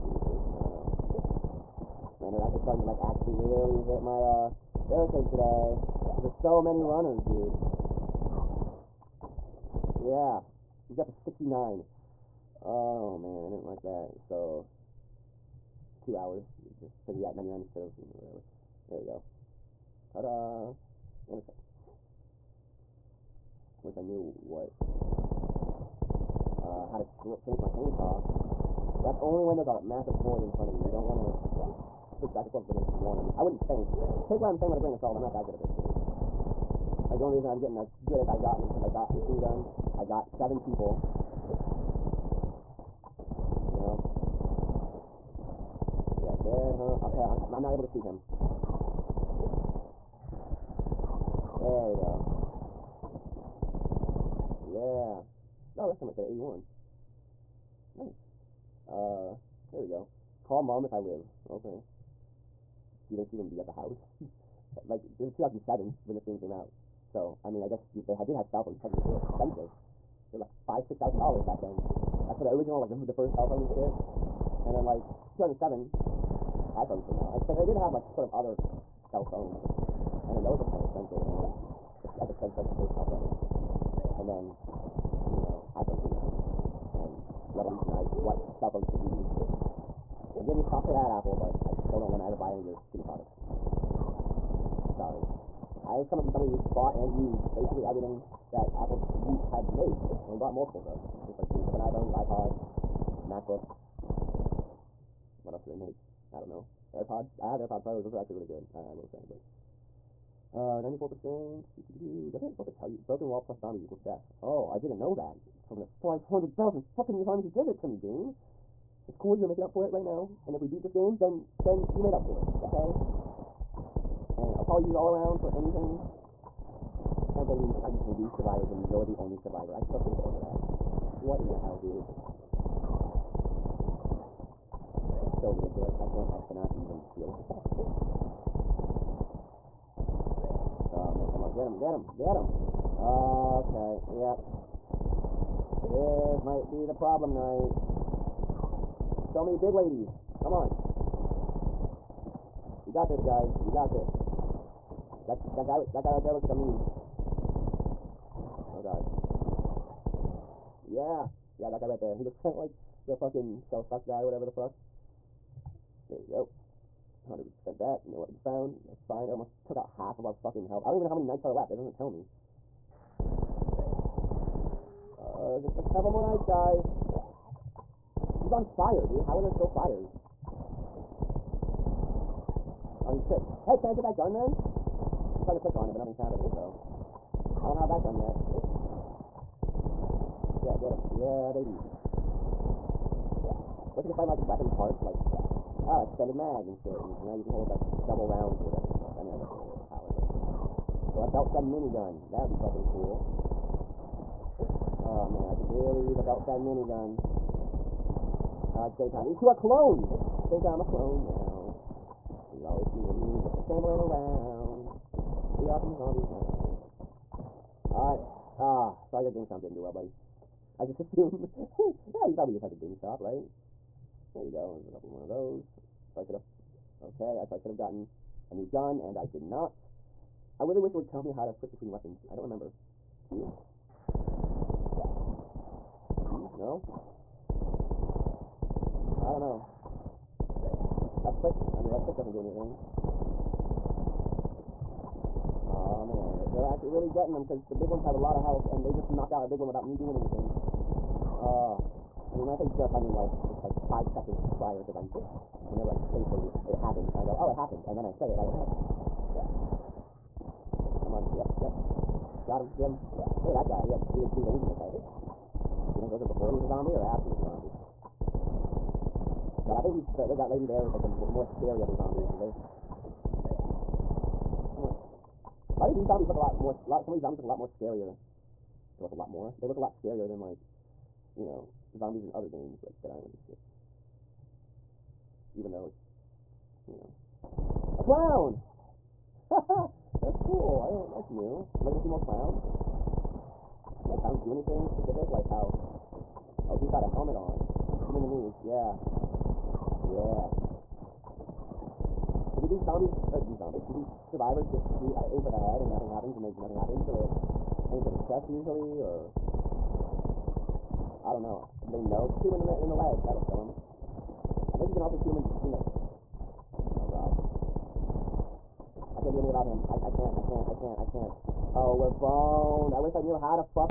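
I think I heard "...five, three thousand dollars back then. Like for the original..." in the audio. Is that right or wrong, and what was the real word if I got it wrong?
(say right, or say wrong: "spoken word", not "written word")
wrong: "six", not "three".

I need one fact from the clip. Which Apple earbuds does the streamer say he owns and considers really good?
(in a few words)
AirPod Pros.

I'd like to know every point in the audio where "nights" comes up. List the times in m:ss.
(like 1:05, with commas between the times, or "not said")
2:27, 2:51, 2:56.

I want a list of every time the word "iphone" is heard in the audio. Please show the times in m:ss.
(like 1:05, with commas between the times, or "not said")
1:16, 1:25, 1:41.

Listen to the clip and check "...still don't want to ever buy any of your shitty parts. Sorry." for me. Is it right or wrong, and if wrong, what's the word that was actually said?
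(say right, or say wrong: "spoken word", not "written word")
wrong: "products", not "parts".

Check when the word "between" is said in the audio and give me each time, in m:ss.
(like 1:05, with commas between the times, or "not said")
3:51, 5:15.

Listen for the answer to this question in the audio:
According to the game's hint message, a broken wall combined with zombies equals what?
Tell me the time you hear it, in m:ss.
1:53.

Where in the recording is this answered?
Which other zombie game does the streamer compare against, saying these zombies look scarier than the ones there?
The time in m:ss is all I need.
4:43.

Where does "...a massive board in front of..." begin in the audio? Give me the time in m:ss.
0:29.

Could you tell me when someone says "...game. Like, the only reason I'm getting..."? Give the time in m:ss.
0:35.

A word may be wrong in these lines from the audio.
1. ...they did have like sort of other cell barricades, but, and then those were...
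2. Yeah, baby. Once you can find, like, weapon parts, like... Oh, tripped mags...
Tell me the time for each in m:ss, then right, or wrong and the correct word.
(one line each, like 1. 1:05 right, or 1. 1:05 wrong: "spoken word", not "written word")
1. 1:17 wrong: "phones", not "barricades"
2. 3:11 wrong: "extended", not "tripped".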